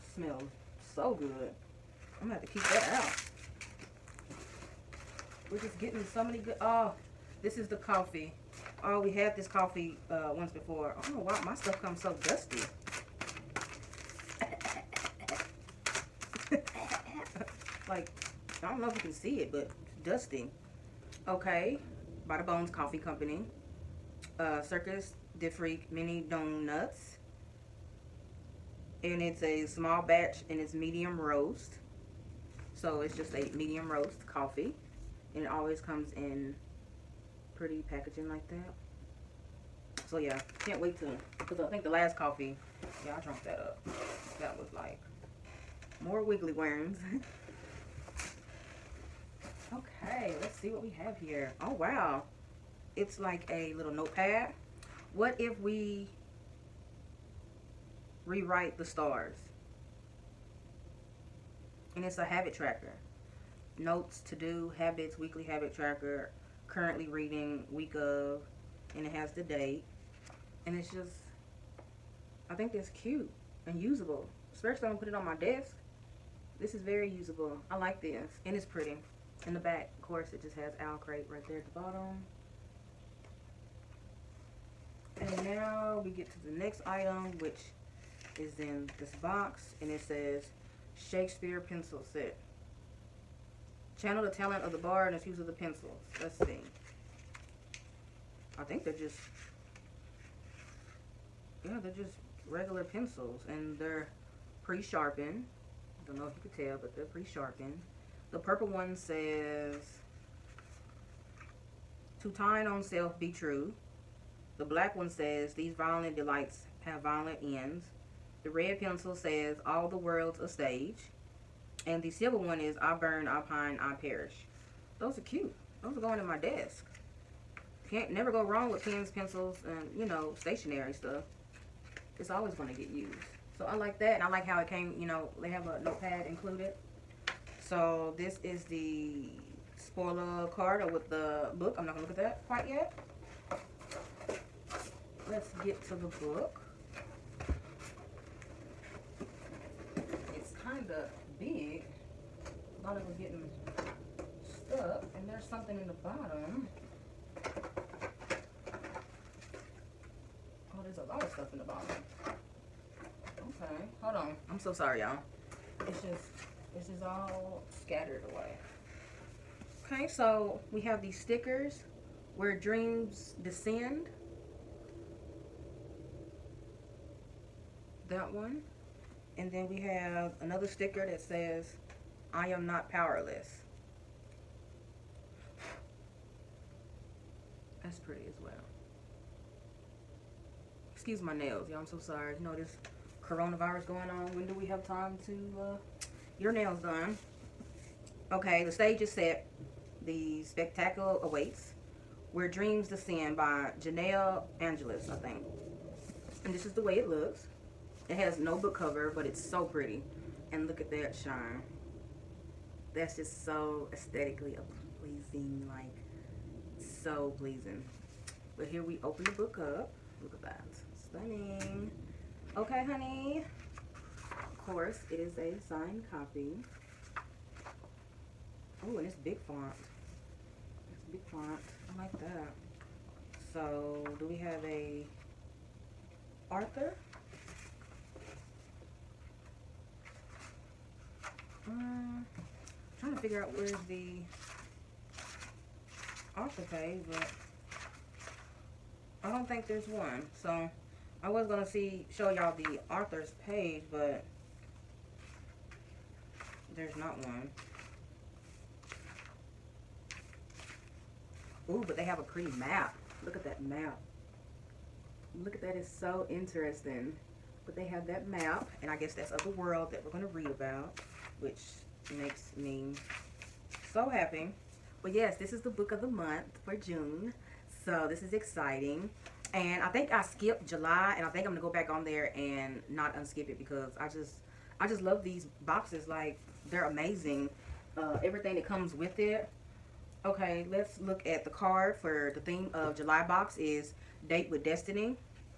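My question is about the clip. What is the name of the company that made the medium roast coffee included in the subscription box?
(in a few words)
Bones Coffee Company.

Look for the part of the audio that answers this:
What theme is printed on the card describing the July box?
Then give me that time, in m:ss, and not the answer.
4:54.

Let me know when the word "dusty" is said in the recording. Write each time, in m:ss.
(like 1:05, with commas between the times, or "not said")
0:12, 0:20.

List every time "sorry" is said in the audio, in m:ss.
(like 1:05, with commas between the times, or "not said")
2:44, 3:11.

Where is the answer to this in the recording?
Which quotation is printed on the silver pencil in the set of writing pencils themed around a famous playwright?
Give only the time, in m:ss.
2:02.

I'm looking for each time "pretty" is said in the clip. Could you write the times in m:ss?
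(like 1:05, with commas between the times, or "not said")
0:37, 1:18, 3:08, 3:29, 4:22.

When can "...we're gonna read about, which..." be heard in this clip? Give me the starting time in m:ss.
4:30.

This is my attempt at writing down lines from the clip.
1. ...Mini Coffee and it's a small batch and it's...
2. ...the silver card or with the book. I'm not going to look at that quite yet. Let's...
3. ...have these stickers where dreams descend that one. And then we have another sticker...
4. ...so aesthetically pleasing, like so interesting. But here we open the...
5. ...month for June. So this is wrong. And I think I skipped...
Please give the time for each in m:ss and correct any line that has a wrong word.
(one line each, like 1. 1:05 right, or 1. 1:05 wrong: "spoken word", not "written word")
1. 0:25 wrong: "Donuts", not "Coffee"
2. 2:18 wrong: "spoiler", not "silver"
3. 2:50 right
4. 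3:33 wrong: "pleasing", not "interesting"
5. 4:36 wrong: "exciting", not "wrong".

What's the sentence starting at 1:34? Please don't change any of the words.
Channel the talent of the bar and its use of the pencils.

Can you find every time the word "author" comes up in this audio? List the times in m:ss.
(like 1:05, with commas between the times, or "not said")
4:06, 4:12.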